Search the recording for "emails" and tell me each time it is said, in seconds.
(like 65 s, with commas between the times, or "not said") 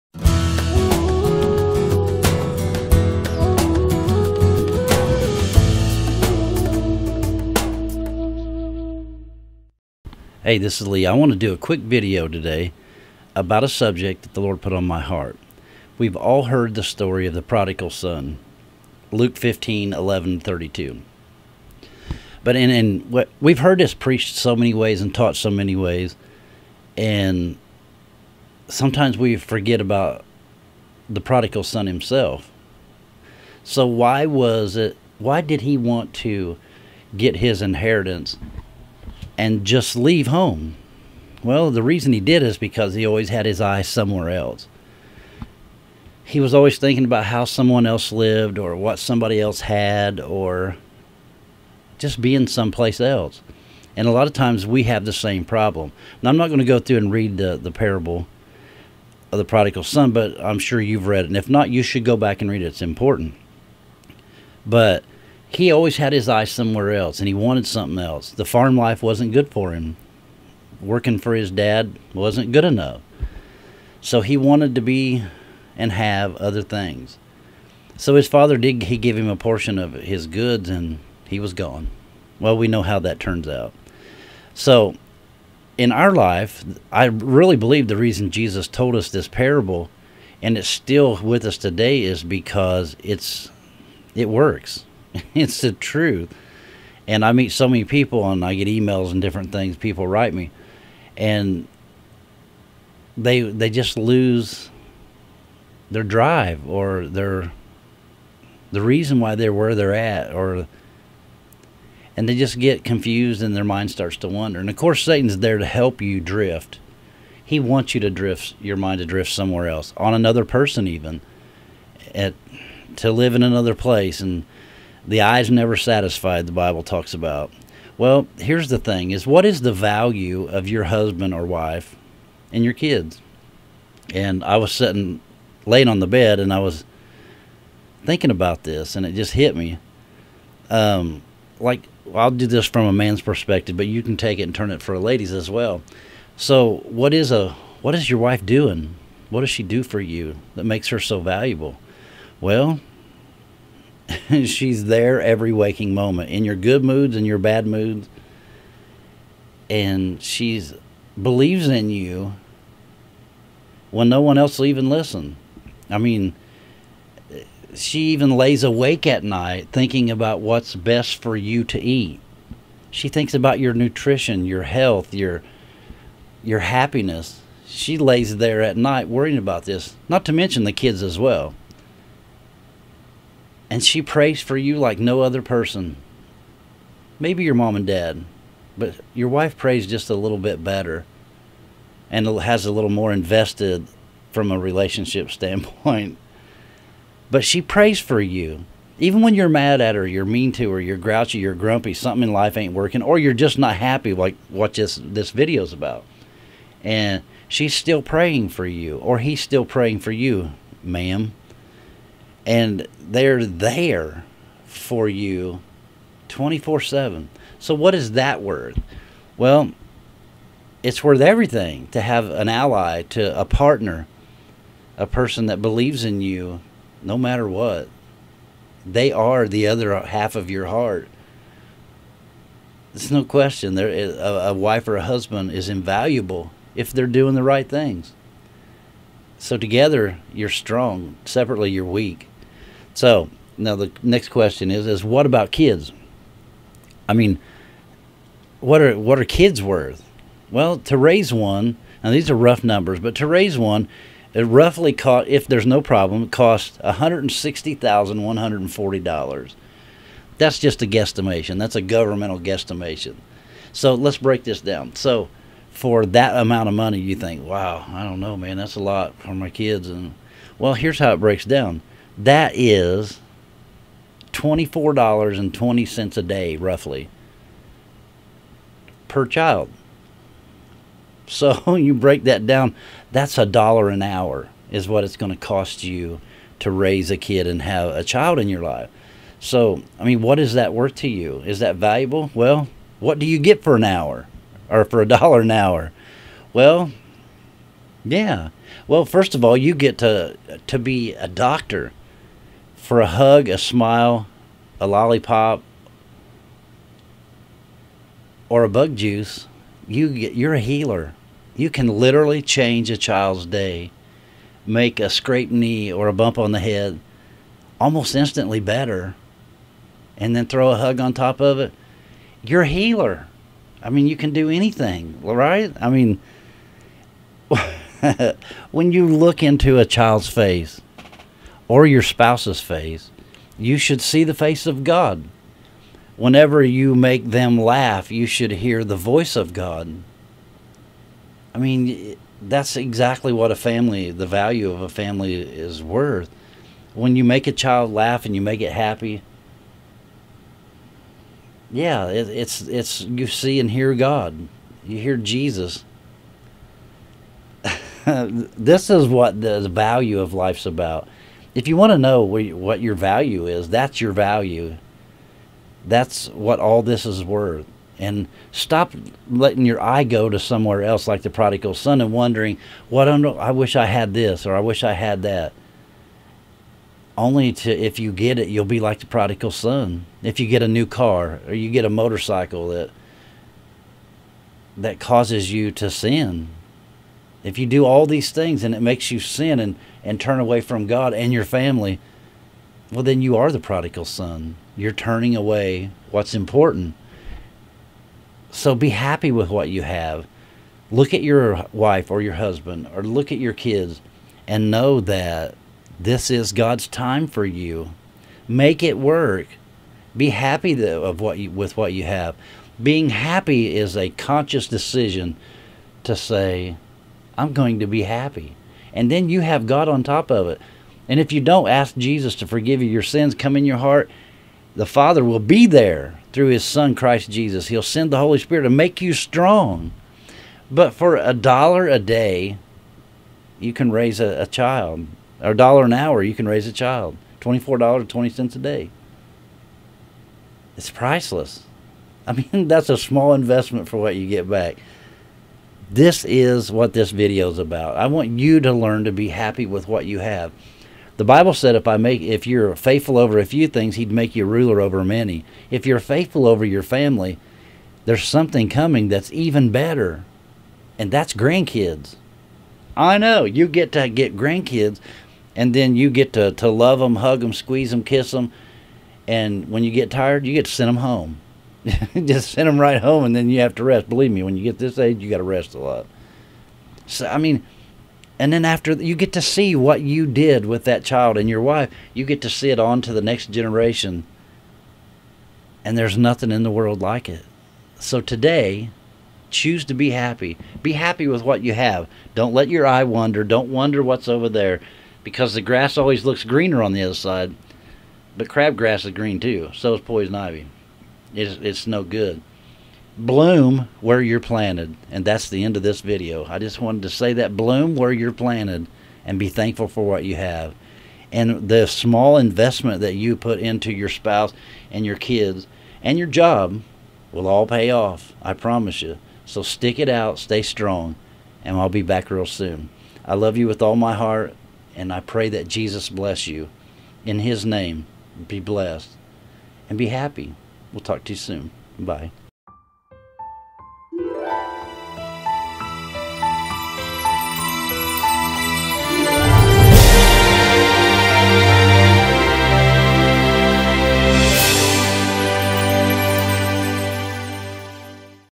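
98 s.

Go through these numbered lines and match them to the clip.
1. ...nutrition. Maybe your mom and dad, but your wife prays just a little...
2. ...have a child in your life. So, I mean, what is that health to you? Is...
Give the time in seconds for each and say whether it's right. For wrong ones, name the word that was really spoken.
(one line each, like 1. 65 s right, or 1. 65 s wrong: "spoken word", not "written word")
1. 185 s wrong: "person", not "nutrition"
2. 287 s wrong: "worth", not "health".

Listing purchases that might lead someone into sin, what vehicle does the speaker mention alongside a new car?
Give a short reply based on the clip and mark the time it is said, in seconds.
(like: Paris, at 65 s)
Motorcycle, at 381 s.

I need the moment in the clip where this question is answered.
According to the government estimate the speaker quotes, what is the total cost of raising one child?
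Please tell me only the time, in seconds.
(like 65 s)
256 s.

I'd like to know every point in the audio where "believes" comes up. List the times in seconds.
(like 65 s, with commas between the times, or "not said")
87 s, 161 s, 225 s, 474 s.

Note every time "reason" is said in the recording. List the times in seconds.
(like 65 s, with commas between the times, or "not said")
41 s, 87 s, 108 s.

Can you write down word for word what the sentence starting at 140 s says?
Um, like I'll do this from a man's perspective, but you can take it and turn it for ladies as well.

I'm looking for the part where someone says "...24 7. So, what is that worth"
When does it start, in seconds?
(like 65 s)
216 s.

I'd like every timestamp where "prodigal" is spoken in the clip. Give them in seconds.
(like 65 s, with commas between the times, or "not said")
17 s, 31 s, 59 s, 371 s, 379 s, 393 s.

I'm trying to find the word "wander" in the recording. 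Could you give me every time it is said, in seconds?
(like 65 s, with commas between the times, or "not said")
114 s, 493 s.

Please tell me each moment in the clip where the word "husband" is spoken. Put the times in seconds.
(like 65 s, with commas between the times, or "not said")
130 s, 235 s, 402 s.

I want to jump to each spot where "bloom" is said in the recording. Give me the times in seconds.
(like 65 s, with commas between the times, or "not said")
503 s, 507 s.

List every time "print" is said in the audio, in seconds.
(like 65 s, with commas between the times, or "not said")
not said.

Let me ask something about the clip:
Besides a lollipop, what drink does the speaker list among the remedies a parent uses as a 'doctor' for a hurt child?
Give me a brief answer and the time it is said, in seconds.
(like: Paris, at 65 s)
Bug juice, at 308 s.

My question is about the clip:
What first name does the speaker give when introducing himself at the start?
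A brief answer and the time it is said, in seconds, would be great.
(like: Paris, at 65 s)
Lee, at 10 s.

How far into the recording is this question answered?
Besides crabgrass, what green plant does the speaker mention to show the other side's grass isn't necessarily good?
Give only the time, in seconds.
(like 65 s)
500 s.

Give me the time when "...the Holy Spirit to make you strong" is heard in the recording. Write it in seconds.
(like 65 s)
428 s.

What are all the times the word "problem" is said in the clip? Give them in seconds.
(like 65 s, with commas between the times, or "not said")
55 s, 255 s.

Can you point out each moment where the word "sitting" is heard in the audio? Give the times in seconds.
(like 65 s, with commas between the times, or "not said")
134 s.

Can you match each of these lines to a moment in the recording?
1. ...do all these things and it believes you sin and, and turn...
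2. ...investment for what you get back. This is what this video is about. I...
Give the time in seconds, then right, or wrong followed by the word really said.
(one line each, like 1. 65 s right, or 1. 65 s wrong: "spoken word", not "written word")
1. 387 s wrong: "makes", not "believes"
2. 443 s right.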